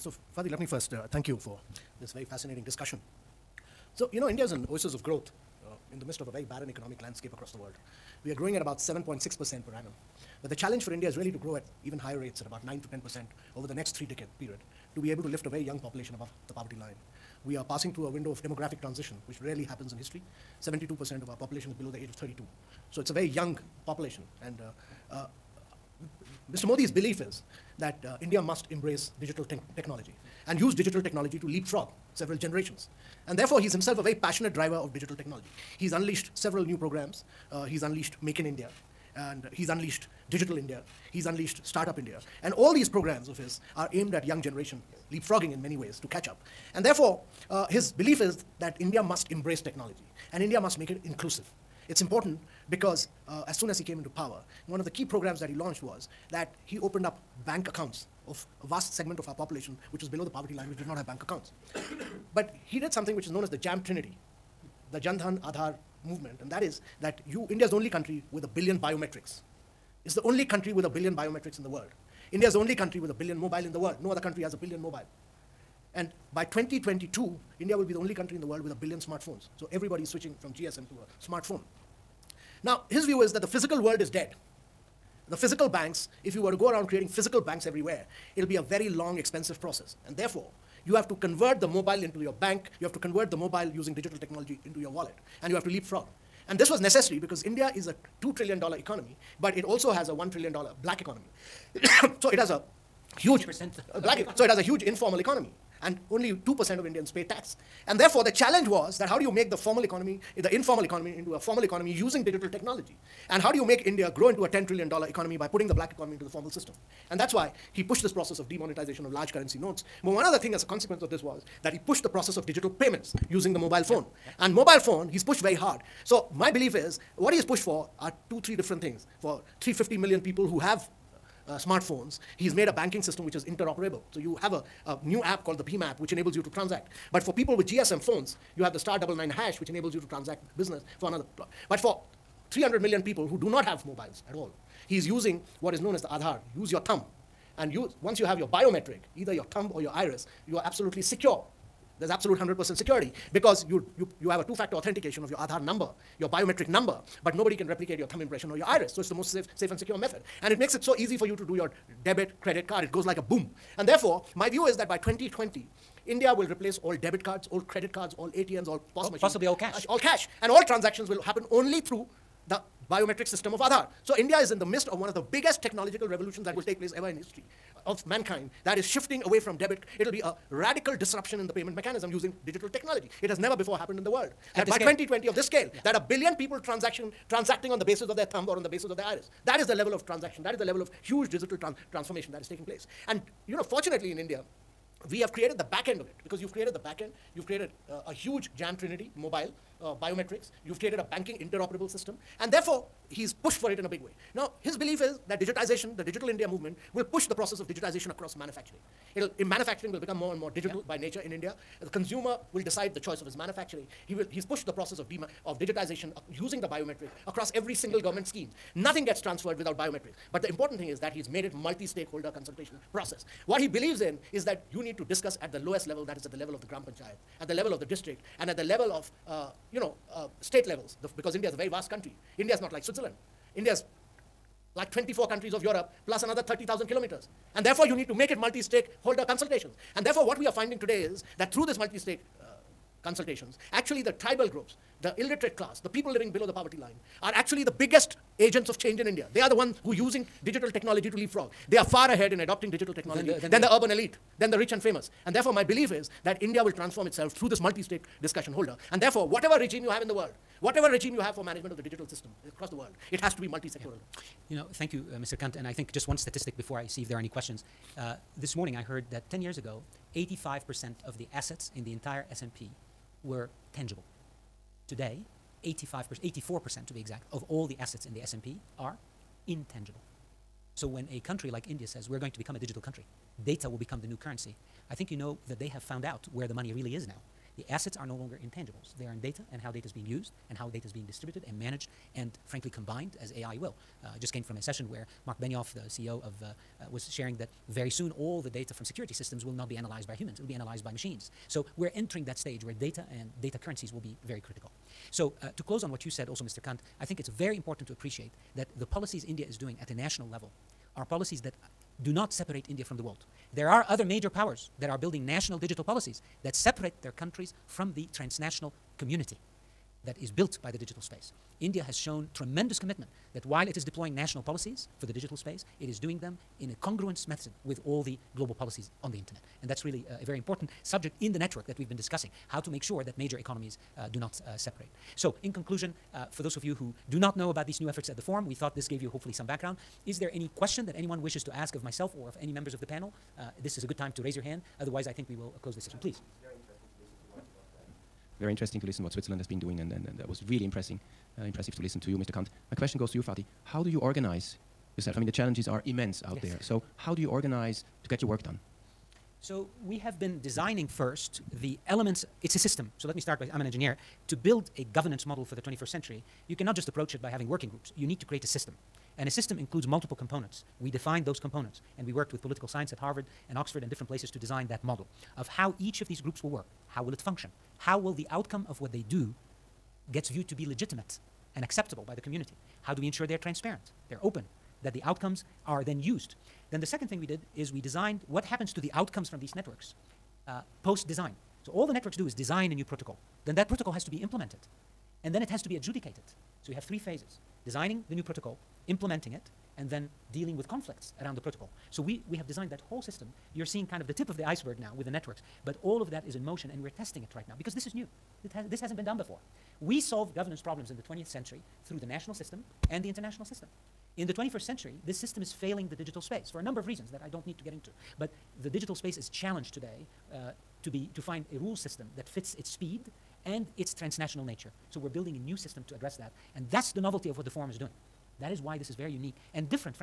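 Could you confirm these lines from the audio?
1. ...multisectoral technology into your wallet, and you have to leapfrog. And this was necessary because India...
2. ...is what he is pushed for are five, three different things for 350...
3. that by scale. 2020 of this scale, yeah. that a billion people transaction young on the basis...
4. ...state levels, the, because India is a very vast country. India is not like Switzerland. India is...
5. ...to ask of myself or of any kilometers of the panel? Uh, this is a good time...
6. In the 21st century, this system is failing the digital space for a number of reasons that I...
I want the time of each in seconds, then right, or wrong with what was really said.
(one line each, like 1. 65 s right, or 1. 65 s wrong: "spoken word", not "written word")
1. 93 s wrong: "digital", not "multisectoral"
2. 126 s wrong: "two", not "five"
3. 184 s wrong: "transacting", not "young"
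4. 230 s right
5. 341 s wrong: "members", not "kilometers"
6. 414 s right.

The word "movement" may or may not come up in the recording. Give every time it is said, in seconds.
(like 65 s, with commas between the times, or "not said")
66 s, 206 s.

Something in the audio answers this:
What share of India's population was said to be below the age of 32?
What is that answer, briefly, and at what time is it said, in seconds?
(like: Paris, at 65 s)
72%, at 20 s.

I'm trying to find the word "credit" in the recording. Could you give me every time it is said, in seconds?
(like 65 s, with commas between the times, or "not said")
162 s, 167 s.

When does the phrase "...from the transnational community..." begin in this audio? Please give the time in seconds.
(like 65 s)
317 s.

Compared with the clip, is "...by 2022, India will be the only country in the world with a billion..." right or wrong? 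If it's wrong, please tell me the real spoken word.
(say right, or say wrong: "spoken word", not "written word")
right.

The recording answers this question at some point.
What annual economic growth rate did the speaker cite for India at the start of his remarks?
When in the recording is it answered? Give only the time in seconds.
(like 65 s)
8 s.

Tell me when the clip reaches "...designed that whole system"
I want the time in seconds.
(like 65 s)
402 s.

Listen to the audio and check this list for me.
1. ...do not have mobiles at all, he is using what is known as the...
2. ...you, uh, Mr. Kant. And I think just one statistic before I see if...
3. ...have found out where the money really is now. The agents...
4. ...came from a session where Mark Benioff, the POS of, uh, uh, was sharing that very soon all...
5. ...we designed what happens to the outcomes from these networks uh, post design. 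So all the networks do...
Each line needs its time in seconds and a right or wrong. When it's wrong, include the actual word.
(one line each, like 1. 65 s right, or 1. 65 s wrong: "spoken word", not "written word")
1. 143 s right
2. 264 s right
3. 285 s wrong: "assets", not "agents"
4. 294 s wrong: "CEO", not "POS"
5. 387 s right.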